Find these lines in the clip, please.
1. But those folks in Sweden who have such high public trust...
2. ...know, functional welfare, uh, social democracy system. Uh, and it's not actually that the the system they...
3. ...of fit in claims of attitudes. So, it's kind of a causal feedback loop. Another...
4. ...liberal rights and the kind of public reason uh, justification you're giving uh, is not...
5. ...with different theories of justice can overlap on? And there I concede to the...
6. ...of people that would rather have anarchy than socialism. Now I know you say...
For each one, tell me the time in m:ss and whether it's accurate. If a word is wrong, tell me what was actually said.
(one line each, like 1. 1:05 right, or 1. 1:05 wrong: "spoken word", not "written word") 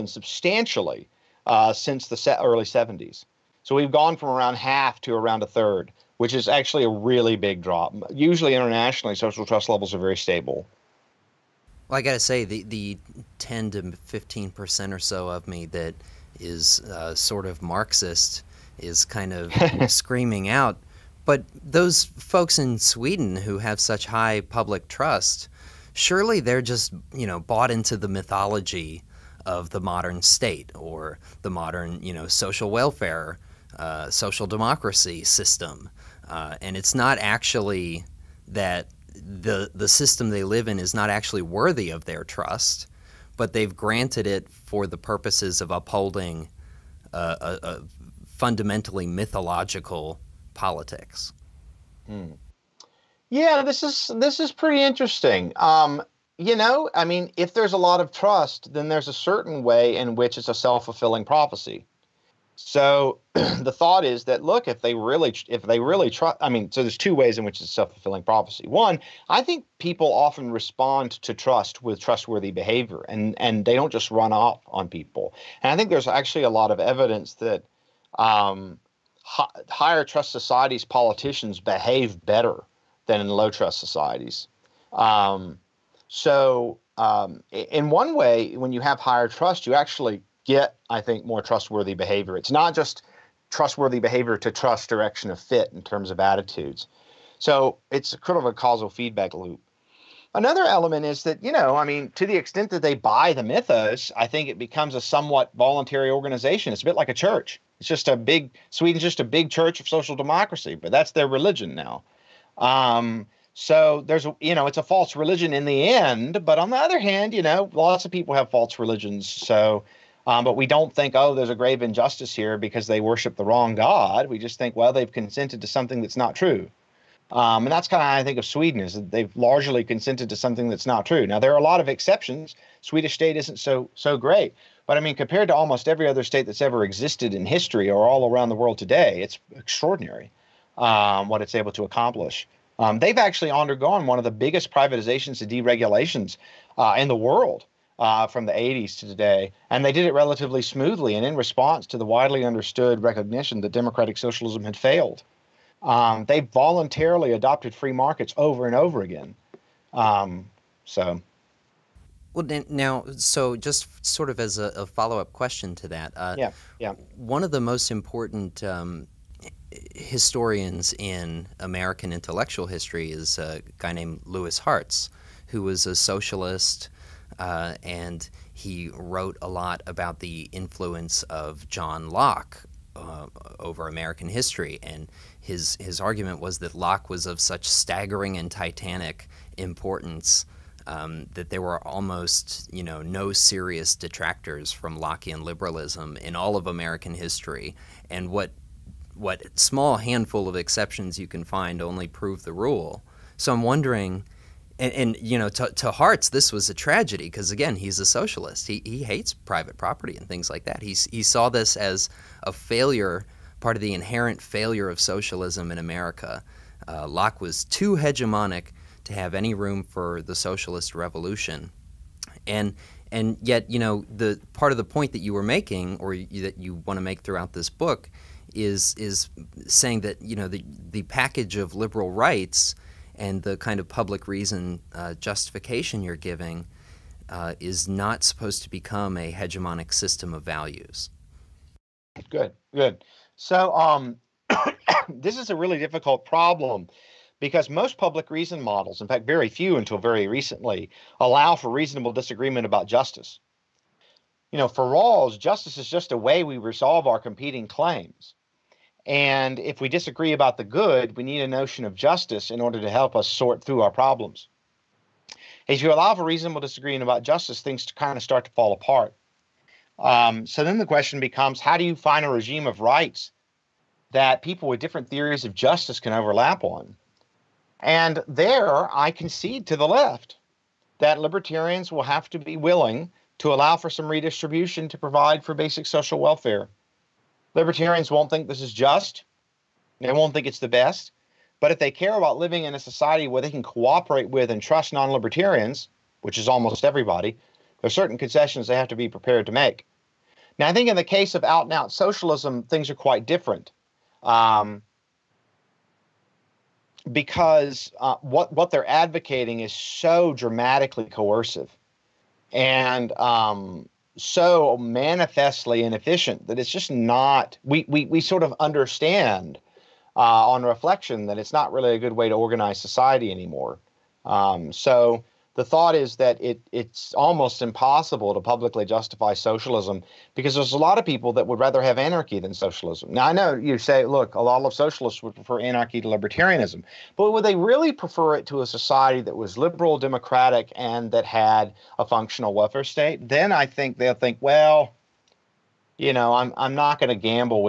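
1. 0:21 right
2. 0:32 wrong: "social", not "functional"
3. 1:35 wrong: "terms", not "claims"
4. 3:51 right
5. 4:34 right
6. 5:30 right.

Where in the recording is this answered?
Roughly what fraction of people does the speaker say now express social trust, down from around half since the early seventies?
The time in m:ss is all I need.
0:05.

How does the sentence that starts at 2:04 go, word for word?
We just think, well, they've consented to something that's not true.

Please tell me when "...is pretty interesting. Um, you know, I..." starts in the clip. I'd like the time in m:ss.
0:54.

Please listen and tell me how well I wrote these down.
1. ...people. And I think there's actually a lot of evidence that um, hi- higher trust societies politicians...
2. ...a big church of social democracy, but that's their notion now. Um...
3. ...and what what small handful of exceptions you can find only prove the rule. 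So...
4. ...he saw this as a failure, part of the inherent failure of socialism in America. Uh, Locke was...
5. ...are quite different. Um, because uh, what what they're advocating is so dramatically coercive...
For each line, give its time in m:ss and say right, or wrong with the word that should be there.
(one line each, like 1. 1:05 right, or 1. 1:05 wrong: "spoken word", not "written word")
1. 1:14 right
2. 1:49 wrong: "religion", not "notion"
3. 3:18 right
4. 3:31 right
5. 5:02 right.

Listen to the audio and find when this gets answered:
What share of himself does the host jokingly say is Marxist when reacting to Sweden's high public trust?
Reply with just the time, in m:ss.
0:13.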